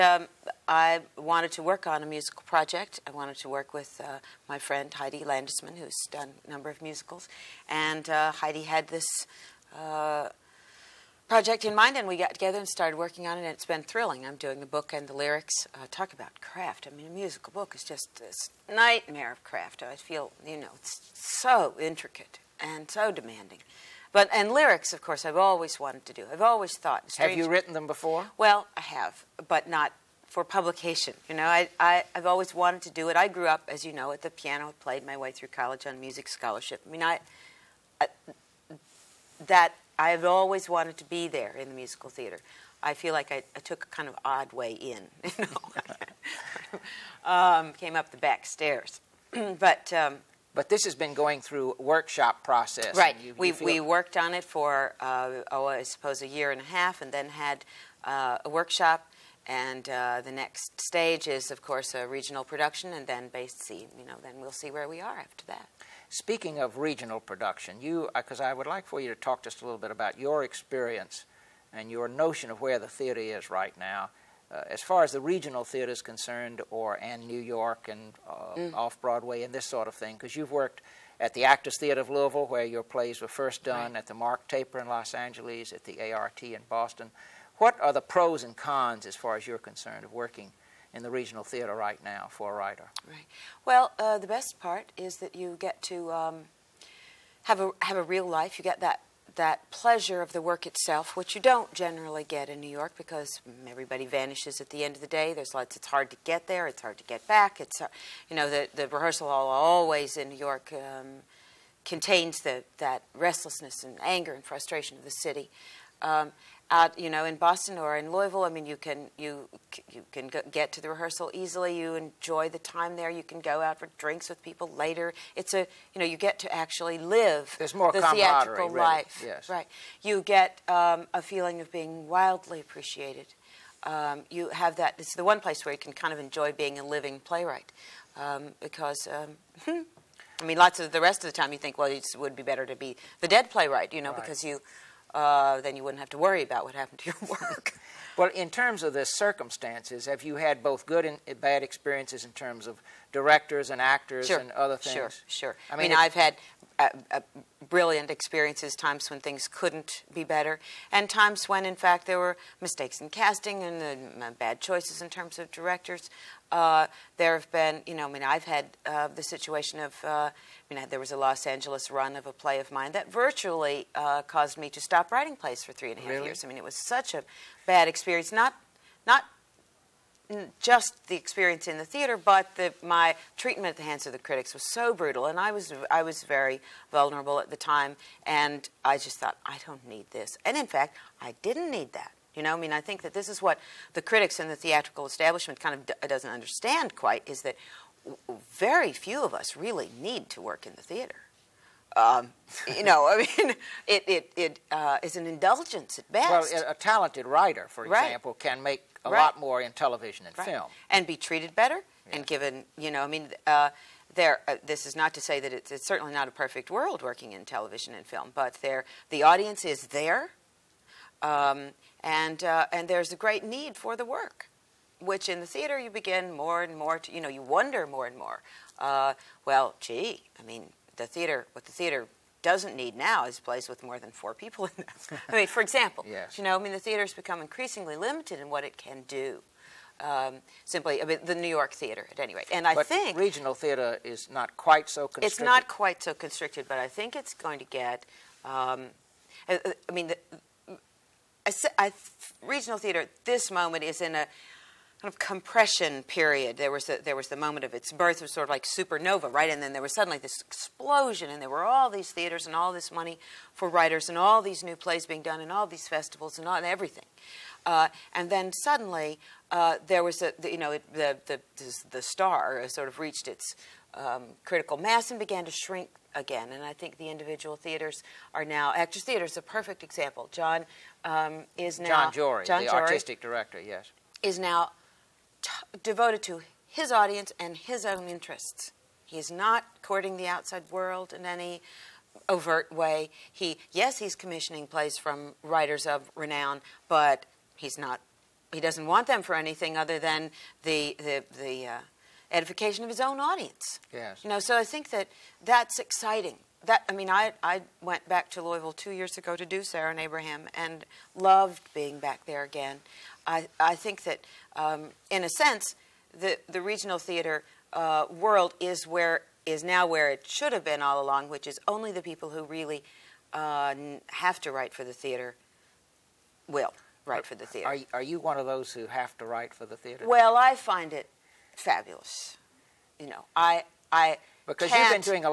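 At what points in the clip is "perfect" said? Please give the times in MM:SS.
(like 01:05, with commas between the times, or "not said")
03:36, 04:39.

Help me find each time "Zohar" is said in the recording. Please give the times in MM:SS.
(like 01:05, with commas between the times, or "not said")
not said.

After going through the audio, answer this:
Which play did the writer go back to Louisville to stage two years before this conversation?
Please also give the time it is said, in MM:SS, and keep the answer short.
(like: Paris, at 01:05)
Sarah and Abraham, at 05:09.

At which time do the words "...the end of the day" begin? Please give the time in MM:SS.
01:44.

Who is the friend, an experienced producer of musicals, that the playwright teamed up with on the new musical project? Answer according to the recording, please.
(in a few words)
Heidi Landesman.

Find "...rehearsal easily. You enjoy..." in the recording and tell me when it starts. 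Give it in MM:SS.
02:00.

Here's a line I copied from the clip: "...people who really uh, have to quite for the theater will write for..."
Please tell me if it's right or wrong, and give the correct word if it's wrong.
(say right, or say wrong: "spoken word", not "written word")
wrong: "write", not "quite".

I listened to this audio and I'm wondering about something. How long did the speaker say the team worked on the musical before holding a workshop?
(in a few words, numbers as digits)
a year and a half.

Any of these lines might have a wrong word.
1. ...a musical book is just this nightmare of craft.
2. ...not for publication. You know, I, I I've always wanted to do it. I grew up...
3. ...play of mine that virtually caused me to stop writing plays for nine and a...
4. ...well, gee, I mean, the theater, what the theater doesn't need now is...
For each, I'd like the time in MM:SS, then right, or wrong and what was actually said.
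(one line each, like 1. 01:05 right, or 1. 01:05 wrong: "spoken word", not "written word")
1. 00:17 right
2. 00:29 right
3. 02:52 wrong: "three", not "nine"
4. 03:49 right.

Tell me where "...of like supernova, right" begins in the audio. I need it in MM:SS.
04:18.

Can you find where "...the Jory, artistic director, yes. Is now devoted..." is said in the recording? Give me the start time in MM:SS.
04:42.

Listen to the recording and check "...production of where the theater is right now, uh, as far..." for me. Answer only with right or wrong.
wrong.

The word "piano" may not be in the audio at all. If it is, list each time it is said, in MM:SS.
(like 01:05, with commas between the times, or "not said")
00:34.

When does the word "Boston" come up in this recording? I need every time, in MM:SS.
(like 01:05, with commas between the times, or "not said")
01:26, 01:57.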